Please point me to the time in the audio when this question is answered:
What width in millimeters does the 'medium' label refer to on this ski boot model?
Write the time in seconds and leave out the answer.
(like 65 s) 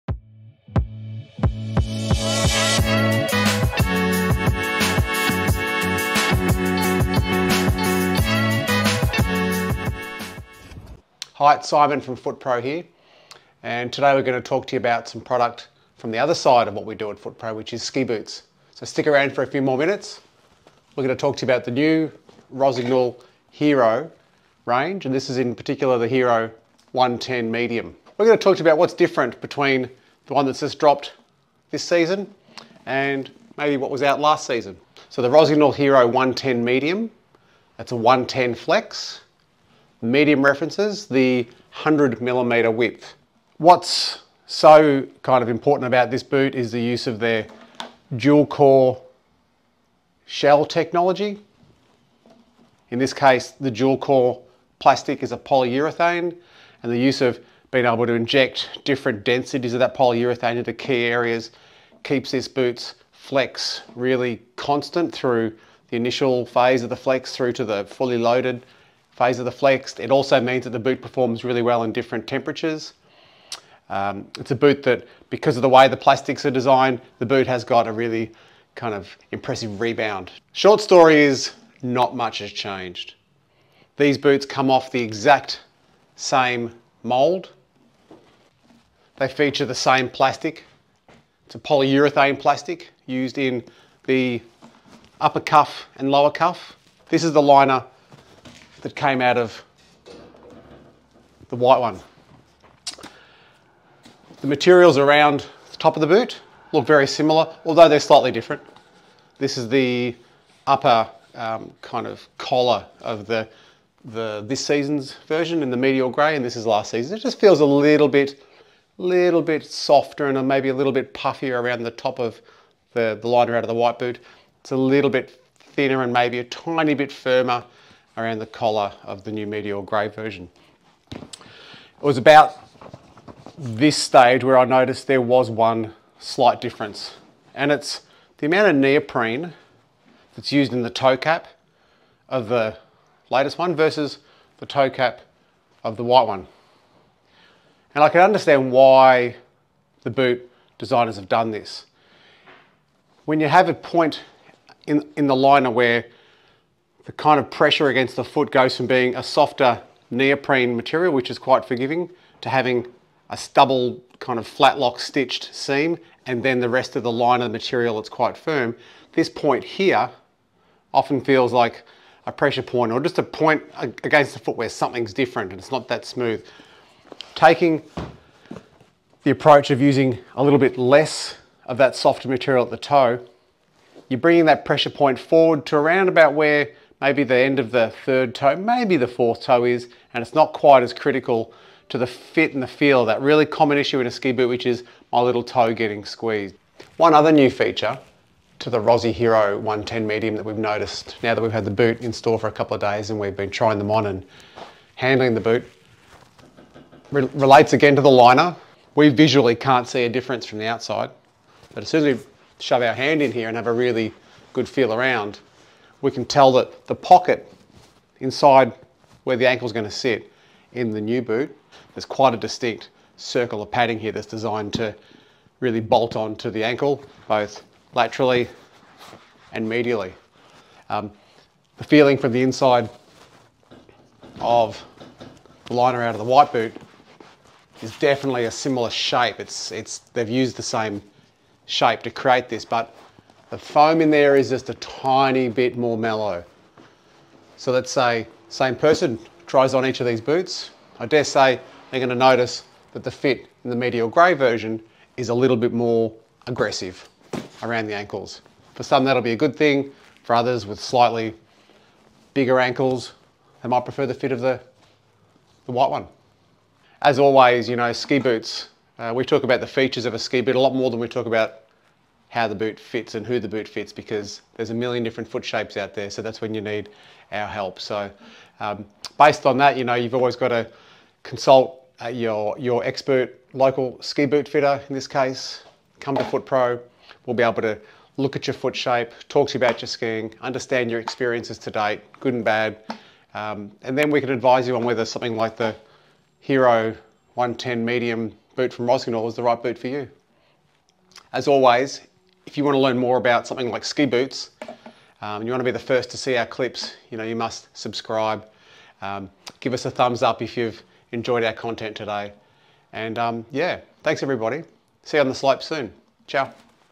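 41 s.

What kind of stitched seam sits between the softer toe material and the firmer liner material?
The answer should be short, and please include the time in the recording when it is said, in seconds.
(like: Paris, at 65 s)
flat lock stitched seam, at 164 s.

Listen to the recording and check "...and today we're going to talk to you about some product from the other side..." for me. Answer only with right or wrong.
right.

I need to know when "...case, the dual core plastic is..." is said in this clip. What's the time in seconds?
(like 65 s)
53 s.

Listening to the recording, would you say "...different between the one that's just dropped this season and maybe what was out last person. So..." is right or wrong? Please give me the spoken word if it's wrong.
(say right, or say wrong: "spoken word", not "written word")
wrong: "season", not "person".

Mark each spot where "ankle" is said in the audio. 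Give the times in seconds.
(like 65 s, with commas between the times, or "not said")
219 s, 226 s, 257 s, 262 s.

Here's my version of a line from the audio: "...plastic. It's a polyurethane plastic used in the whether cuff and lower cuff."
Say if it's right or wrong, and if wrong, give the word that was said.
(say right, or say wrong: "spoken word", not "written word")
wrong: "upper", not "whether".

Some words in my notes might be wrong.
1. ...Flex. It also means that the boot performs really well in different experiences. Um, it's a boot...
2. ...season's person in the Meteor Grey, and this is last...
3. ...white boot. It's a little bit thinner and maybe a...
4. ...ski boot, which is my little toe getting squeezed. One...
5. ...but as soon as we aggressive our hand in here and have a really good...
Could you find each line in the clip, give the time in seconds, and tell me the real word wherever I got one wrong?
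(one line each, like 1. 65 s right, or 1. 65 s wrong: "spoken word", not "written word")
1. 69 s wrong: "temperatures", not "experiences"
2. 114 s wrong: "version", not "person"
3. 123 s right
4. 194 s right
5. 211 s wrong: "shove", not "aggressive".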